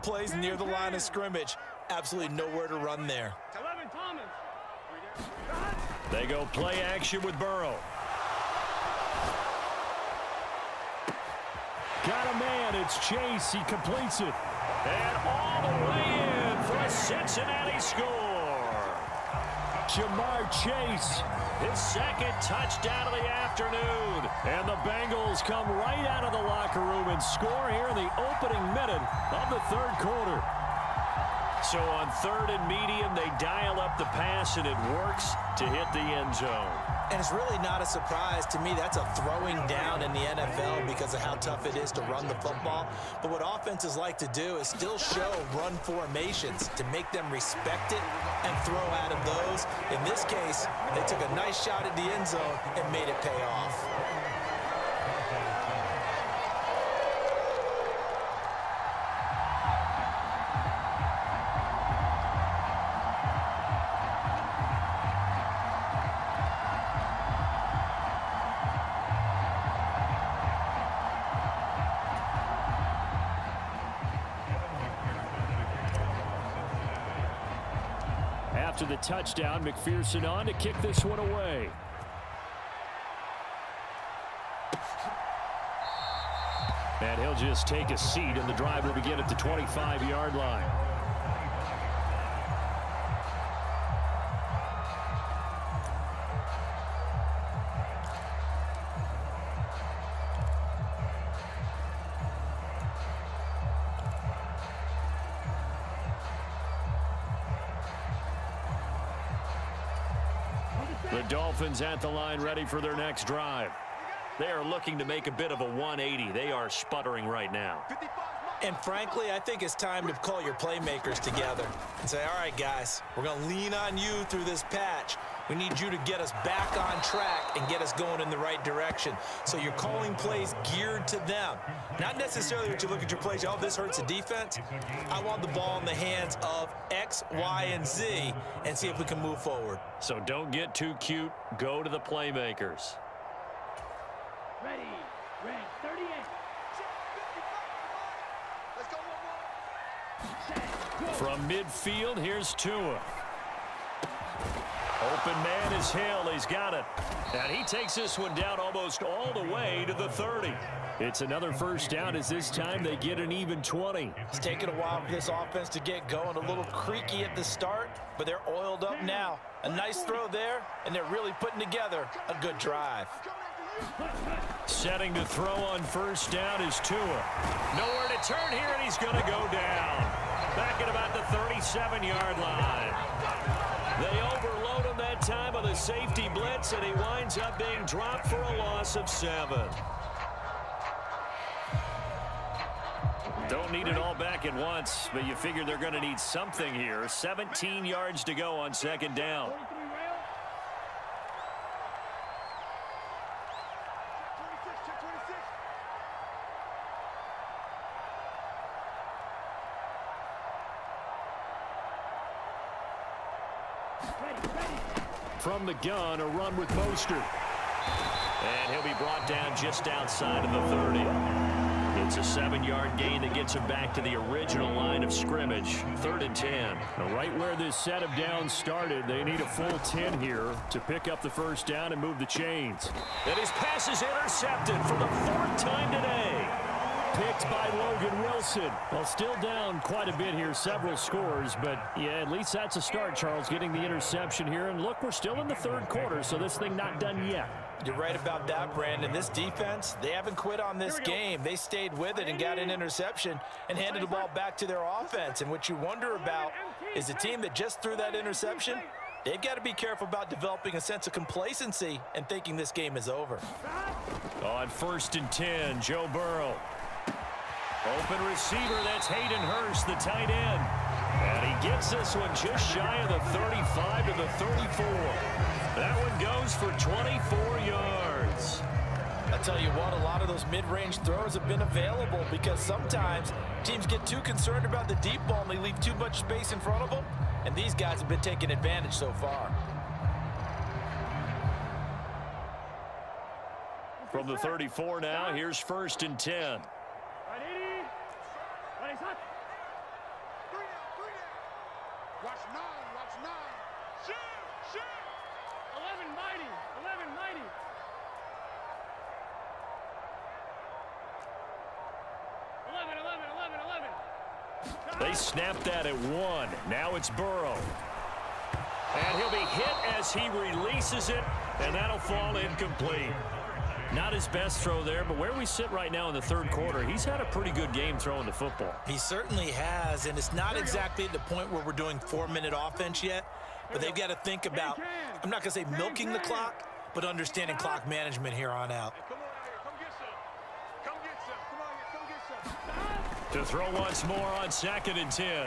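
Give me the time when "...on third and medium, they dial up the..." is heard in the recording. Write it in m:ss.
0:31.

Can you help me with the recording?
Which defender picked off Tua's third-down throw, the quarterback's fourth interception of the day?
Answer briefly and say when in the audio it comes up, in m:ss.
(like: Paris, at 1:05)
Logan Wilson, at 3:57.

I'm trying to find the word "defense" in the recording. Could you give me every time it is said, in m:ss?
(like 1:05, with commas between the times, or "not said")
2:14, 4:09.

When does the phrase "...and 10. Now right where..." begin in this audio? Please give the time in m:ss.
3:46.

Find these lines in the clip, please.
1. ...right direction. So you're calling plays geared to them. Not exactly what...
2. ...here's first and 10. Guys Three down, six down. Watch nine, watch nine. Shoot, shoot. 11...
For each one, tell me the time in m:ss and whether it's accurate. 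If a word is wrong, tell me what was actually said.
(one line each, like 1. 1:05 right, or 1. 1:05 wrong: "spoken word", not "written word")
1. 2:08 wrong: "necessarily", not "exactly"
2. 4:55 wrong: "three", not "six".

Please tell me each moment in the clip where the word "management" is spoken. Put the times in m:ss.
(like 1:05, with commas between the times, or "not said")
5:37.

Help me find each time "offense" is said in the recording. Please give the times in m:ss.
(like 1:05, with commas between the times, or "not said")
0:43, 2:45, 4:14, 5:32.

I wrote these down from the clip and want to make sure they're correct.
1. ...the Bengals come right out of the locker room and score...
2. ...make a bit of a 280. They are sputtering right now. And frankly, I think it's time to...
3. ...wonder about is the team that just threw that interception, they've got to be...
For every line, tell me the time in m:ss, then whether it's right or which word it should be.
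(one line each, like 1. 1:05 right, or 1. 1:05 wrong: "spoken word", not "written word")
1. 0:24 right
2. 1:55 wrong: "180", not "280"
3. 4:15 right.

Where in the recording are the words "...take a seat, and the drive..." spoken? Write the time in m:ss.
1:27.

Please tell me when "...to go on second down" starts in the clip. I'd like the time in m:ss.
3:18.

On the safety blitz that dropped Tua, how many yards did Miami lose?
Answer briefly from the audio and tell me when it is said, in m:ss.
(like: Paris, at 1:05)
7, at 3:08.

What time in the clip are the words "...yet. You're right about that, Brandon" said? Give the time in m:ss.
4:07.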